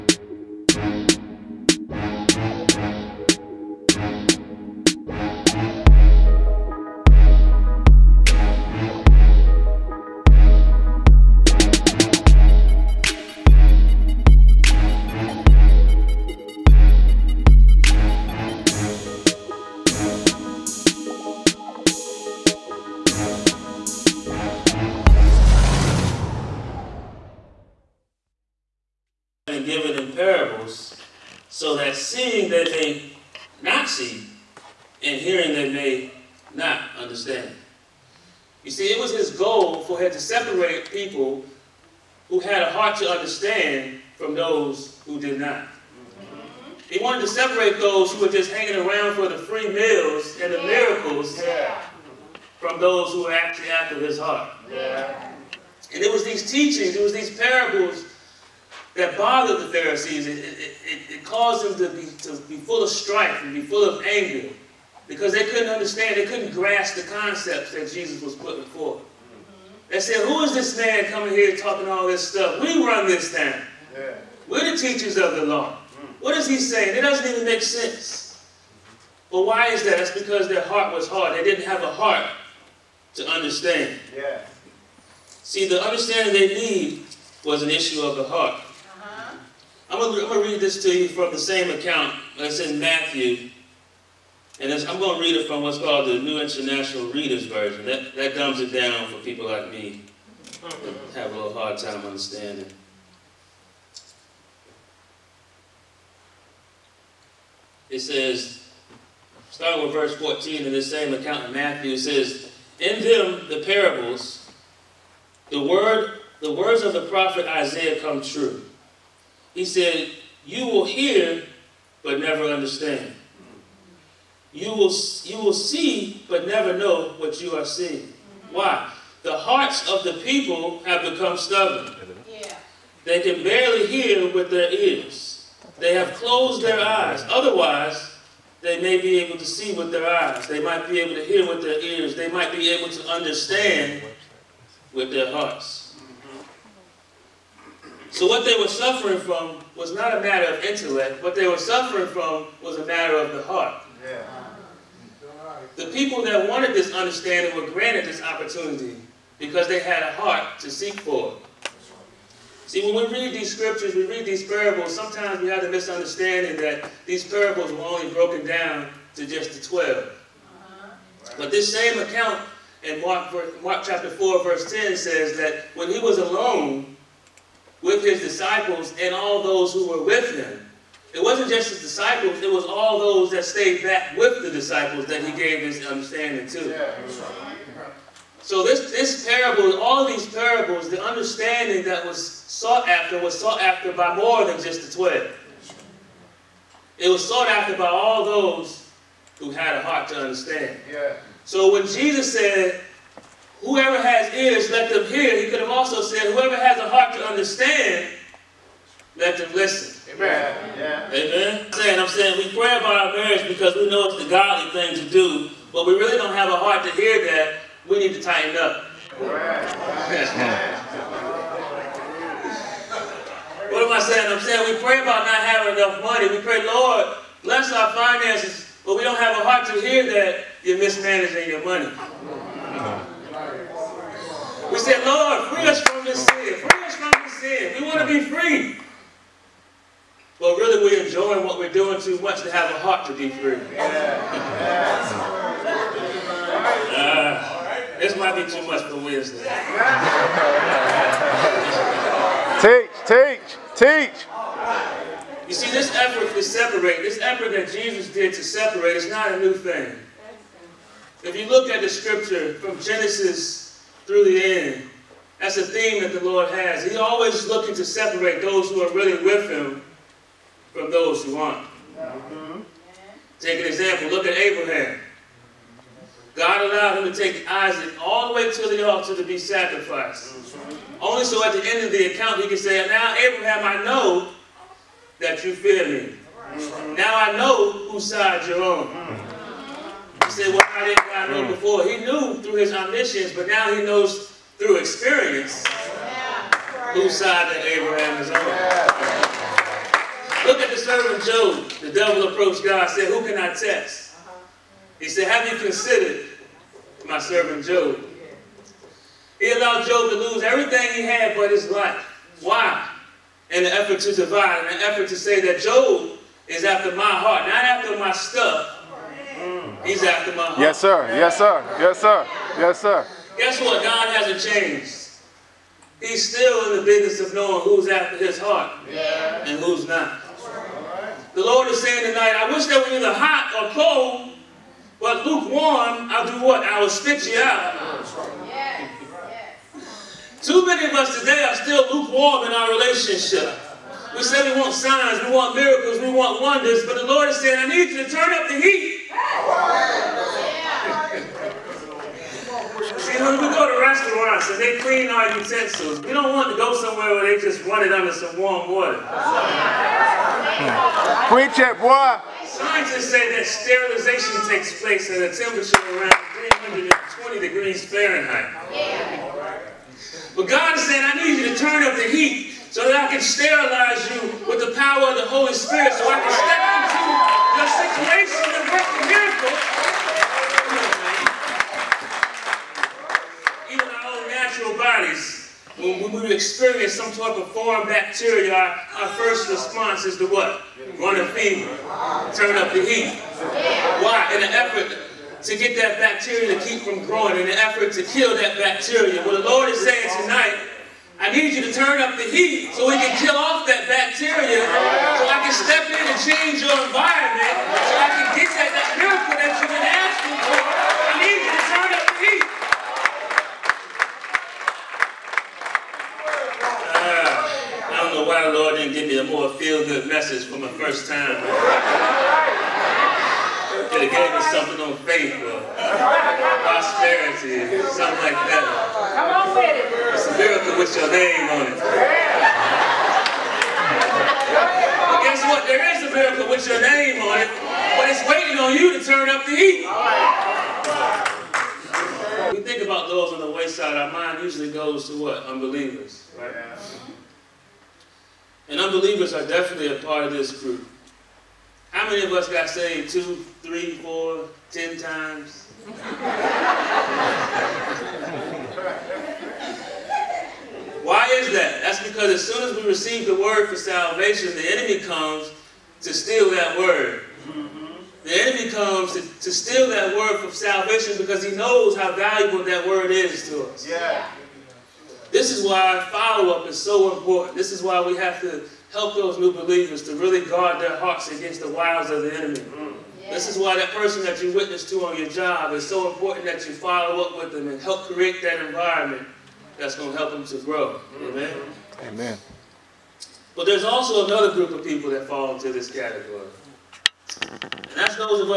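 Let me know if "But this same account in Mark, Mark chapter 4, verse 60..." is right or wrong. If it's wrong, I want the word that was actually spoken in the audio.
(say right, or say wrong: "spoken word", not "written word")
wrong: "10", not "60".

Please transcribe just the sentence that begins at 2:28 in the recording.
So what they were suffering from was not a matter of intellect.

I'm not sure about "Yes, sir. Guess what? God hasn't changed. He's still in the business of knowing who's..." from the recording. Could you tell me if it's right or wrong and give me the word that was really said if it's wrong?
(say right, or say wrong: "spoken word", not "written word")
right.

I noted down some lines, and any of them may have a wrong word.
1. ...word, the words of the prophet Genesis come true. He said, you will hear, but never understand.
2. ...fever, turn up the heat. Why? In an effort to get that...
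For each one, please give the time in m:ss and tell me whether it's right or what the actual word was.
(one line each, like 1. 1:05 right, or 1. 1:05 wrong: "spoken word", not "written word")
1. 1:55 wrong: "Isaiah", not "Genesis"
2. 6:31 right.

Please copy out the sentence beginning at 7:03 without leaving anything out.
Could have gave me something on faith or prosperity or something like that.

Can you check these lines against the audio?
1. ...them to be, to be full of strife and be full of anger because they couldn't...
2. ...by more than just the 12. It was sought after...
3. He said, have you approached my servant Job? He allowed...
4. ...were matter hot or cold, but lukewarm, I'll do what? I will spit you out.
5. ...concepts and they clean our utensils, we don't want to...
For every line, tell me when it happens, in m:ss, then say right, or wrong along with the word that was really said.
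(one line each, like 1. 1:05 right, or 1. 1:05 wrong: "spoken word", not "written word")
1. 1:01 right
2. 3:13 right
3. 5:04 wrong: "considered", not "approached"
4. 5:32 wrong: "either", not "matter"
5. 5:53 wrong: "restaurants", not "concepts".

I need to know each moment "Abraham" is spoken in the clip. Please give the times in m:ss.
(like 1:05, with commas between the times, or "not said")
4:34, 4:43, 4:57.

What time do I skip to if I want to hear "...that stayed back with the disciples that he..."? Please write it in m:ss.
3:03.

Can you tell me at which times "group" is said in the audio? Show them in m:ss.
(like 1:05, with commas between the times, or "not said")
7:30, 8:14.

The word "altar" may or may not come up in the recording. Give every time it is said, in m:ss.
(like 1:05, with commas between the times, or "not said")
4:38.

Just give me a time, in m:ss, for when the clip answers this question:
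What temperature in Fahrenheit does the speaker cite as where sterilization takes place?
6:06.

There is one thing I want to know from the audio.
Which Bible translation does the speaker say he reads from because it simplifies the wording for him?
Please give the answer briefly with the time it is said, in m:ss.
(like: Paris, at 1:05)
New International Reader's Version, at 1:36.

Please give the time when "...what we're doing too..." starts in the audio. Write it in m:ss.
4:01.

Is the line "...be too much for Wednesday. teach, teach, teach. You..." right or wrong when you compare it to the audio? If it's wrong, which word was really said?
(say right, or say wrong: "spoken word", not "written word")
right.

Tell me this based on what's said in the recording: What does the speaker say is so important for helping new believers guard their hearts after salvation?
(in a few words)
Follow-up.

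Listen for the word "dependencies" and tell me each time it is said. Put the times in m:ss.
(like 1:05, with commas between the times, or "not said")
not said.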